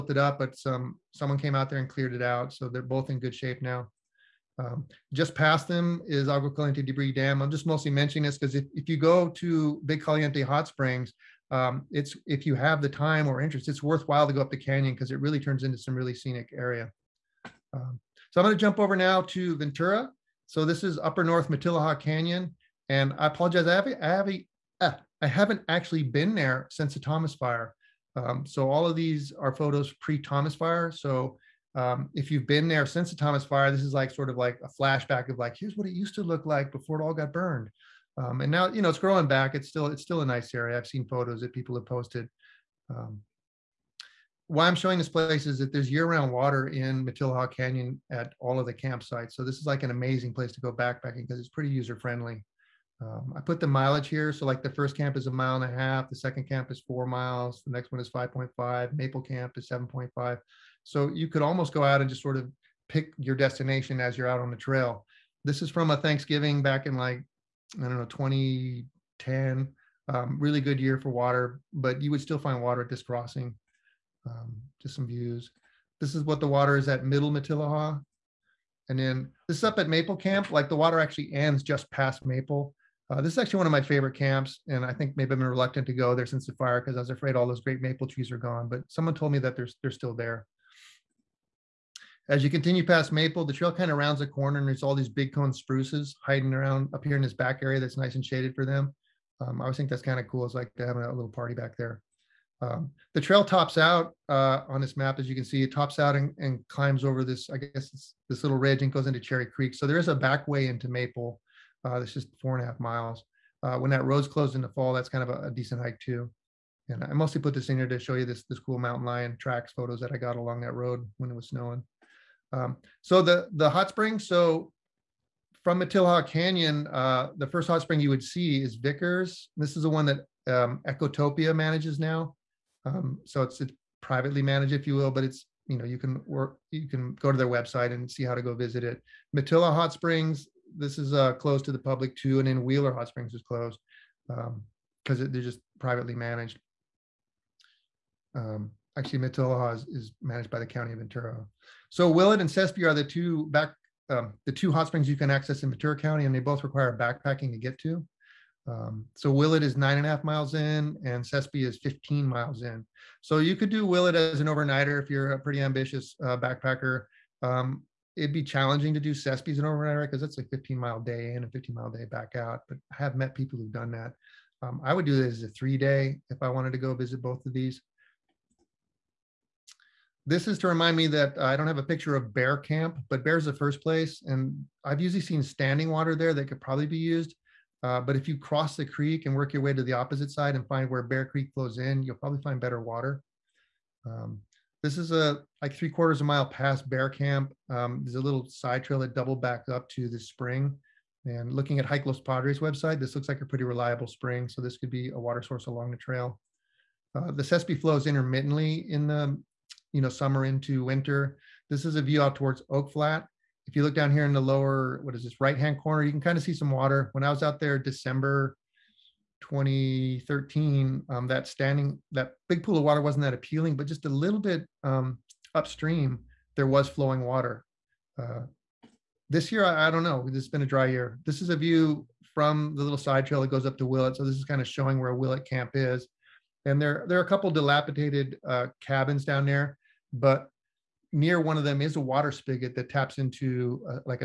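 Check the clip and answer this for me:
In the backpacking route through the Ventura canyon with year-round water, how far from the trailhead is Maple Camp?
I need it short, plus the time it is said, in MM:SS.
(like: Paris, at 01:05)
7.5 miles, at 00:58.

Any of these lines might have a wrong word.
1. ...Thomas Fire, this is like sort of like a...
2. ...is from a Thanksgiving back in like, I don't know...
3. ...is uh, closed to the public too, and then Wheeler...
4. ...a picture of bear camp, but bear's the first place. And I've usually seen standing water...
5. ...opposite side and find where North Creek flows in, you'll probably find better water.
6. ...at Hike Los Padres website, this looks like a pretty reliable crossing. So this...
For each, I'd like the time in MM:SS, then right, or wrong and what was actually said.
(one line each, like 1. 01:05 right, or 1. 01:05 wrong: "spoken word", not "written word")
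1. 00:33 right
2. 01:05 right
3. 02:20 right
4. 03:01 right
5. 03:09 wrong: "Bear", not "North"
6. 03:21 wrong: "spring", not "crossing".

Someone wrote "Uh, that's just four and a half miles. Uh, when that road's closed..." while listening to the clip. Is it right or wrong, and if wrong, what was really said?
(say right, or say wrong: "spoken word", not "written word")
right.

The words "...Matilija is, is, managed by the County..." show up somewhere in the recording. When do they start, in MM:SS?
02:29.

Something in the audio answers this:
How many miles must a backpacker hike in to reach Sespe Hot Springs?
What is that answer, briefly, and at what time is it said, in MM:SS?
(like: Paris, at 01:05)
15 miles, at 02:41.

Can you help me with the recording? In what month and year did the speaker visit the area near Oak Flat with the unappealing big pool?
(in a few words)
December 2013.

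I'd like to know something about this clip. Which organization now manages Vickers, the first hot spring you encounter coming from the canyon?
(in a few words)
Ecotopia.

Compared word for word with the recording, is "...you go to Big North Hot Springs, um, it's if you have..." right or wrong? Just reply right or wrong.
wrong.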